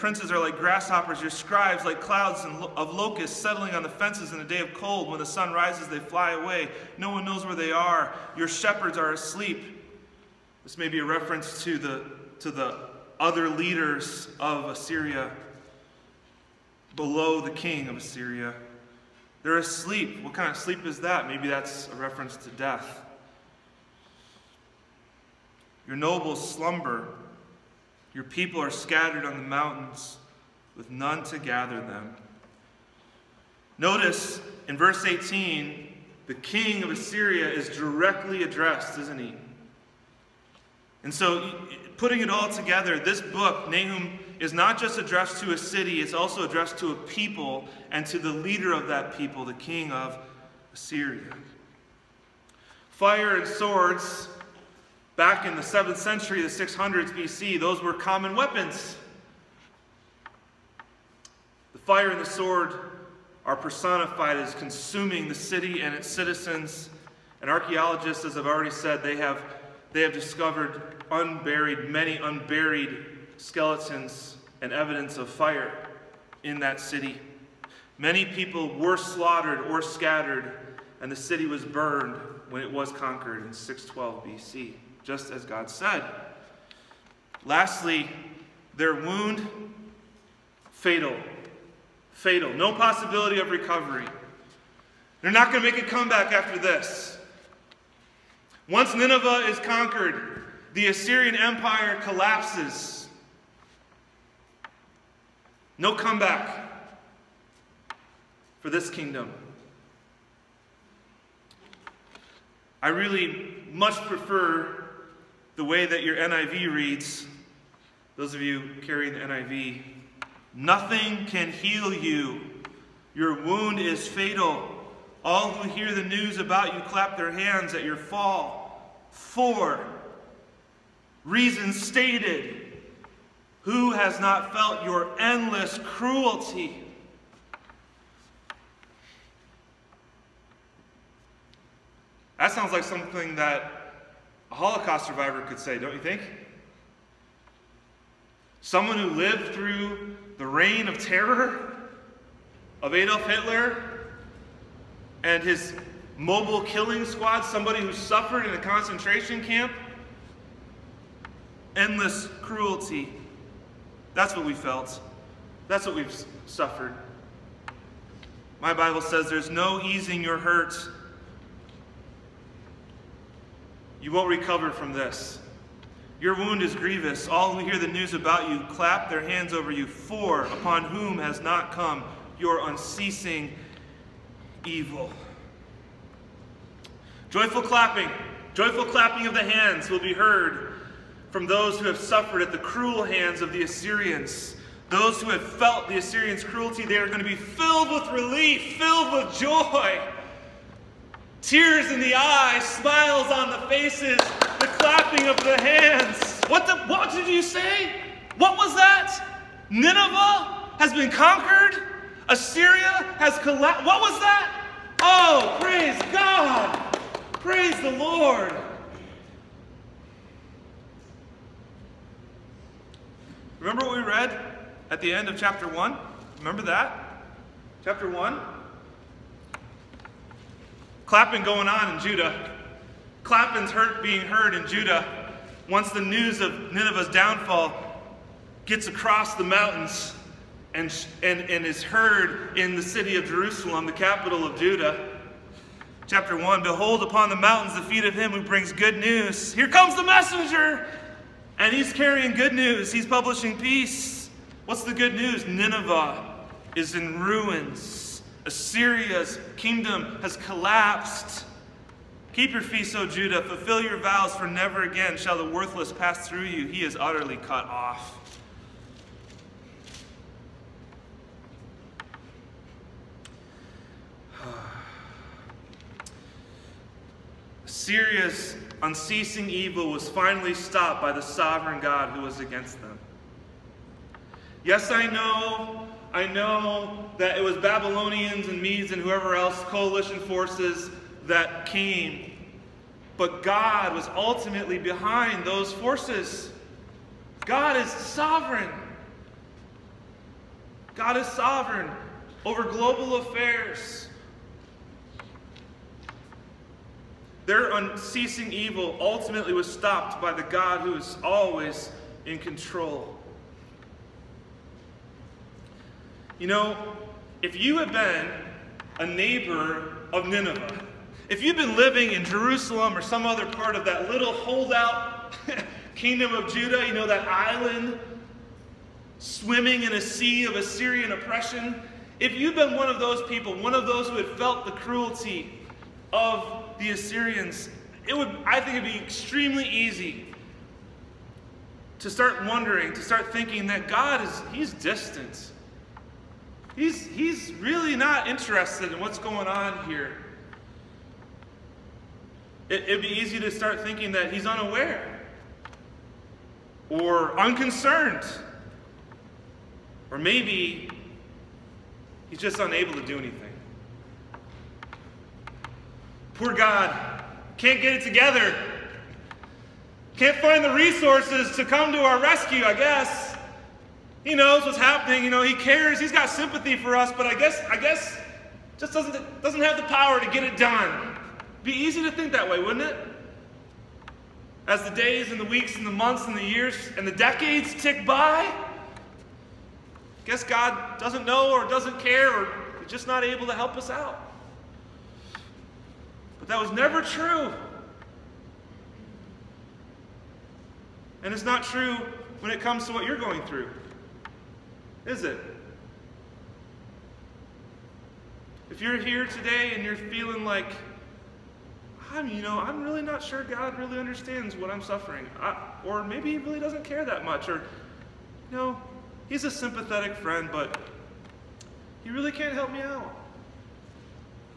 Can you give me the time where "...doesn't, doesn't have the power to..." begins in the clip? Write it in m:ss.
6:18.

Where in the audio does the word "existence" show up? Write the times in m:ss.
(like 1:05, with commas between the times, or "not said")
not said.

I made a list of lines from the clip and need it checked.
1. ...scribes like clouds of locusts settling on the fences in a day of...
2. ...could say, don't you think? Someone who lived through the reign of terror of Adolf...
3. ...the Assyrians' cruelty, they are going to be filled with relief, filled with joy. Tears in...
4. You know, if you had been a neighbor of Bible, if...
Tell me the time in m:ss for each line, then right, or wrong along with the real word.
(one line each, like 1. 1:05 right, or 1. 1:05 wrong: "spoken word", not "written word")
1. 0:01 right
2. 2:25 right
3. 3:15 right
4. 5:16 wrong: "Nineveh", not "Bible".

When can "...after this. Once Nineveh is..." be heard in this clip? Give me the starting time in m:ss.
1:36.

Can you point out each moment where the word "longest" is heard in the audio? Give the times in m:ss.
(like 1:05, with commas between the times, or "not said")
not said.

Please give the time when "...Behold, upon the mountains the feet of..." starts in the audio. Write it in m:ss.
4:06.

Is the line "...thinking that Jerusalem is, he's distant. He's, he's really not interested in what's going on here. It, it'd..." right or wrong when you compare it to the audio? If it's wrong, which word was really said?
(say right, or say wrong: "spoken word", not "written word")
wrong: "God", not "Jerusalem".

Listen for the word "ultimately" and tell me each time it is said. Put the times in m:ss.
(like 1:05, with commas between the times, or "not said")
4:54, 5:08.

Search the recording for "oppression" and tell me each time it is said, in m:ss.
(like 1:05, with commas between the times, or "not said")
5:31.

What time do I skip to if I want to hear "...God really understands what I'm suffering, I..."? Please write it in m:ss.
6:53.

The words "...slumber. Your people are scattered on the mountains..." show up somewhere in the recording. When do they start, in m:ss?
0:26.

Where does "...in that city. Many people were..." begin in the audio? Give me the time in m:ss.
1:16.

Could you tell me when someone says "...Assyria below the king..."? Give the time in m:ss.
0:14.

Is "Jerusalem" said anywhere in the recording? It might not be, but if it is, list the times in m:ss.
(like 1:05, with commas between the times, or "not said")
4:03, 5:22.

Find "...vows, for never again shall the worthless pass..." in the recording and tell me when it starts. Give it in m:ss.
4:23.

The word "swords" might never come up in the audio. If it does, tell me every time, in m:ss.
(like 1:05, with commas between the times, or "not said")
0:53, 1:02.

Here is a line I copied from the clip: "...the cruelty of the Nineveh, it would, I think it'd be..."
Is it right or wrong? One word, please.
wrong.